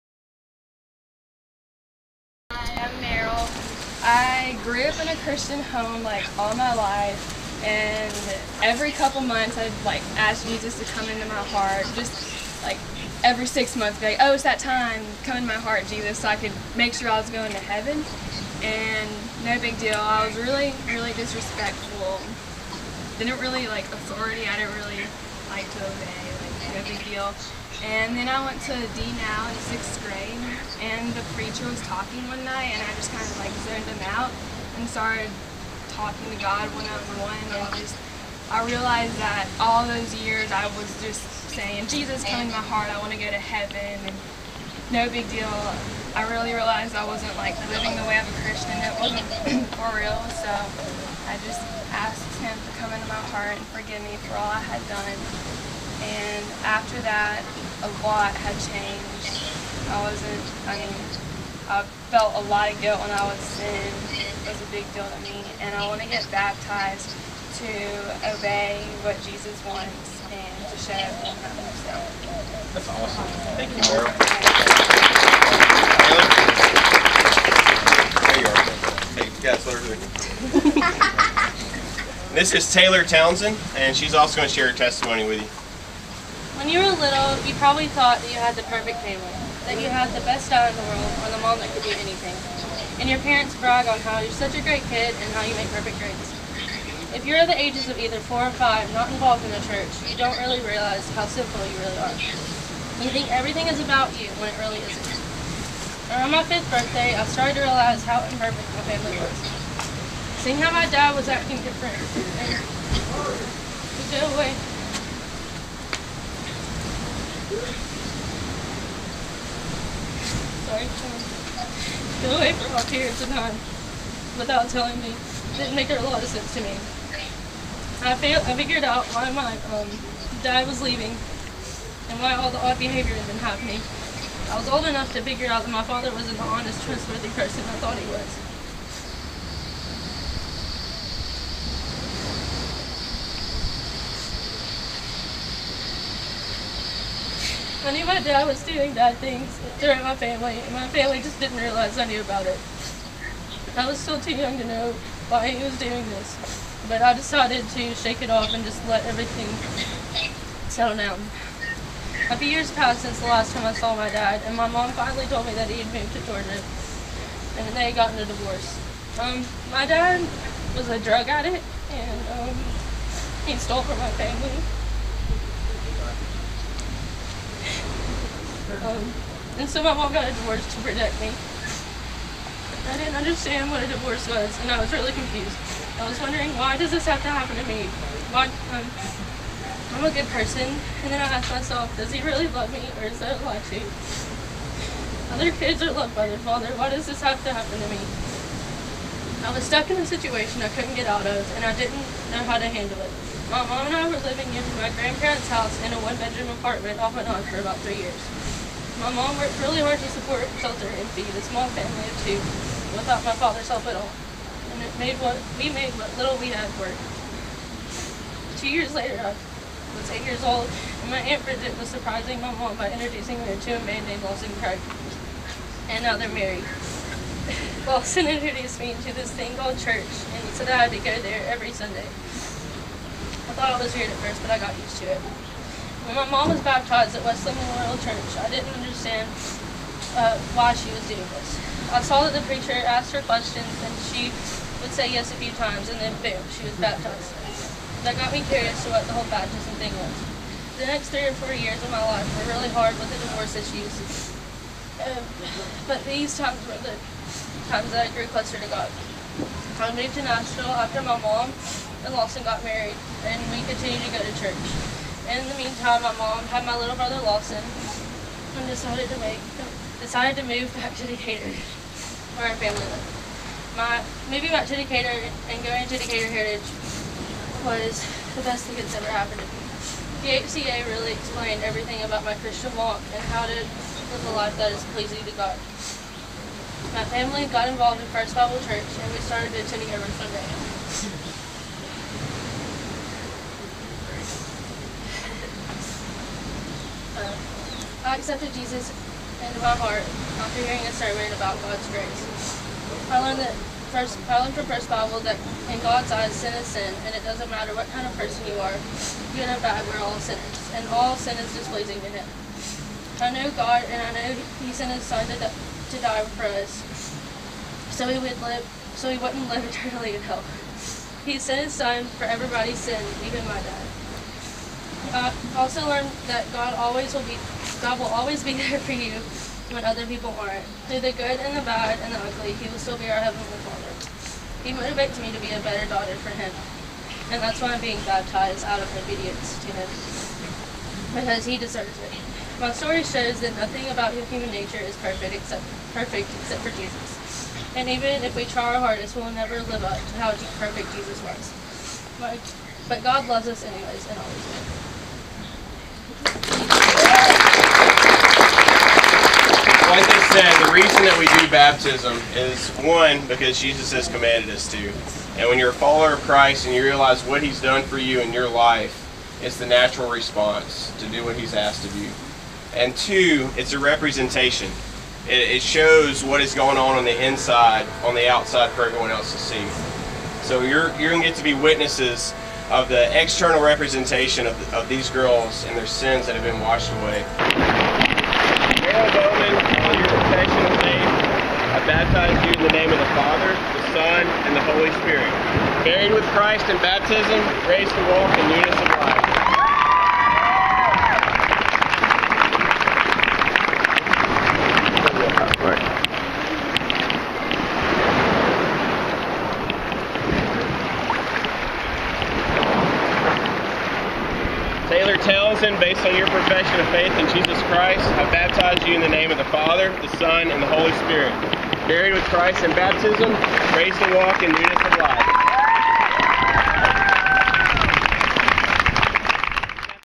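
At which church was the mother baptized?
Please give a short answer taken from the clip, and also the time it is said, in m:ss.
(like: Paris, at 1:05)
Wesleyan Memorial Church, at 3:57.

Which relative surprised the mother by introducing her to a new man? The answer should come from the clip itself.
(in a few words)
Aunt Bridget.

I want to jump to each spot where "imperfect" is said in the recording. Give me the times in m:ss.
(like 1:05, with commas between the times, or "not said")
1:48.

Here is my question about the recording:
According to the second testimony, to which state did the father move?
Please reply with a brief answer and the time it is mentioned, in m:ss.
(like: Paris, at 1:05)
Georgia, at 2:46.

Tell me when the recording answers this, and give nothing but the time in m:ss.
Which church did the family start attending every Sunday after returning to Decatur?
4:48.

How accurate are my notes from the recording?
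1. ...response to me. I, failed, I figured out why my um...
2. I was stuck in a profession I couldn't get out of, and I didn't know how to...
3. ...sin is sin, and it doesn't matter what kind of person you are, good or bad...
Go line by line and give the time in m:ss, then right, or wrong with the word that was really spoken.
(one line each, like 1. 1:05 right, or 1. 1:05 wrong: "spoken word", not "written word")
1. 2:06 wrong: "sense", not "response"
2. 3:19 wrong: "situation", not "profession"
3. 5:06 right.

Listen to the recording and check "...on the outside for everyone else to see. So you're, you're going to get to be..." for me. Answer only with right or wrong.
right.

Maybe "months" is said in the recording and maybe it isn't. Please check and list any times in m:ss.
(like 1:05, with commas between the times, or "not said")
0:09, 0:13.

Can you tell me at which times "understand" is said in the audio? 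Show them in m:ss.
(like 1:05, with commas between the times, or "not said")
3:03, 3:58.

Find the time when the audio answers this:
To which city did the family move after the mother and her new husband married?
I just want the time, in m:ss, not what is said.
4:20.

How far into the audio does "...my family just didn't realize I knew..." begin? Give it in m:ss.
2:30.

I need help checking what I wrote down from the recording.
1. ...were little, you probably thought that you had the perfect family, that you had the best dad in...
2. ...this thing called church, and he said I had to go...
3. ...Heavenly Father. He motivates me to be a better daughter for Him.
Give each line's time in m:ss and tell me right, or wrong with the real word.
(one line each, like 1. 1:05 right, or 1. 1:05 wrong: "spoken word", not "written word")
1. 1:26 right
2. 3:49 right
3. 5:33 right.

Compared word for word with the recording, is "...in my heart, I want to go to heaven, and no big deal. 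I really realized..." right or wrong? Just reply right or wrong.
right.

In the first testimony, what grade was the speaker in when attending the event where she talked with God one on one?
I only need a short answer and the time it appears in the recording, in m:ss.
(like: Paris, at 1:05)
6th grade, at 0:29.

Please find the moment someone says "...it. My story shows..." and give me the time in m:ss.
5:42.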